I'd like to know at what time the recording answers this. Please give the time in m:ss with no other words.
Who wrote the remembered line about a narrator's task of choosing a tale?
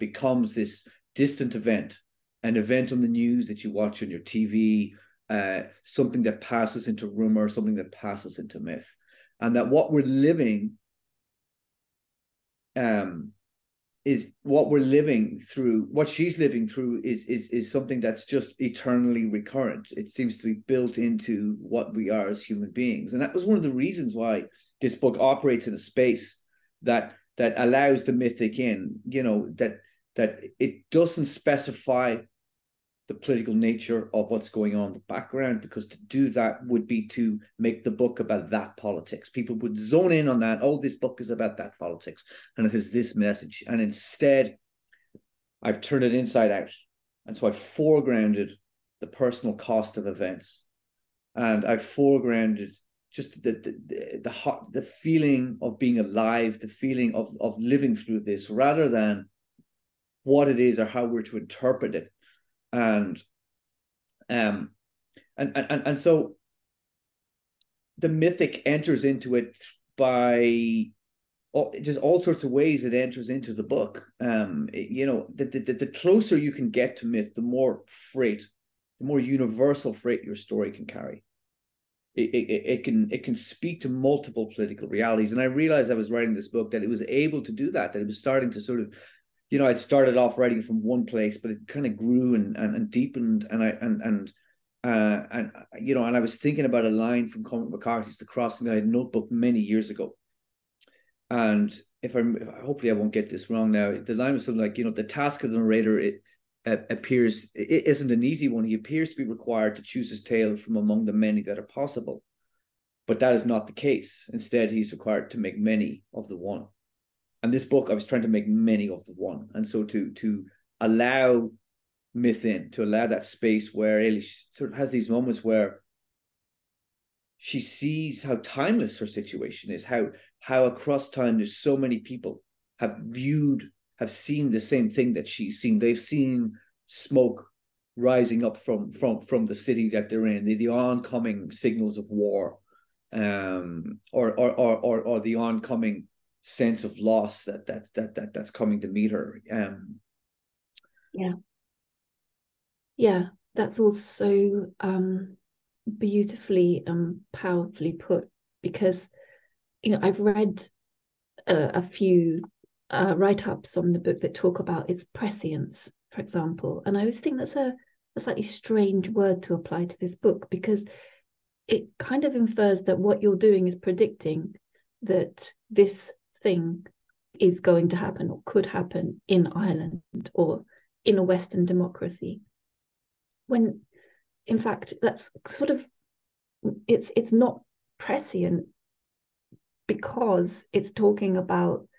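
1:37.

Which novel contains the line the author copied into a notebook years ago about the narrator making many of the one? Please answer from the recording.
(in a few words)
The Crossing.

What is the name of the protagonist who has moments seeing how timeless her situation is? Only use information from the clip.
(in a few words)
Eilish.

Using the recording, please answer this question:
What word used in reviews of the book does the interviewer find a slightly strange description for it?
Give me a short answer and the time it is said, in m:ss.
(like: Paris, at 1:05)
prescience, at 2:45.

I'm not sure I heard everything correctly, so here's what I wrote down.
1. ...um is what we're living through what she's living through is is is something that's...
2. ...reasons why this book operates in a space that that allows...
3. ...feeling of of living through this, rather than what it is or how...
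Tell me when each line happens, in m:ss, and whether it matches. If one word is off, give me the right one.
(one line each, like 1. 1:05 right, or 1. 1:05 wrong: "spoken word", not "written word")
1. 0:12 right
2. 0:23 right
3. 0:56 right.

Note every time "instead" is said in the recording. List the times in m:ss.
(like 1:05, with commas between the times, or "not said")
0:43, 1:54.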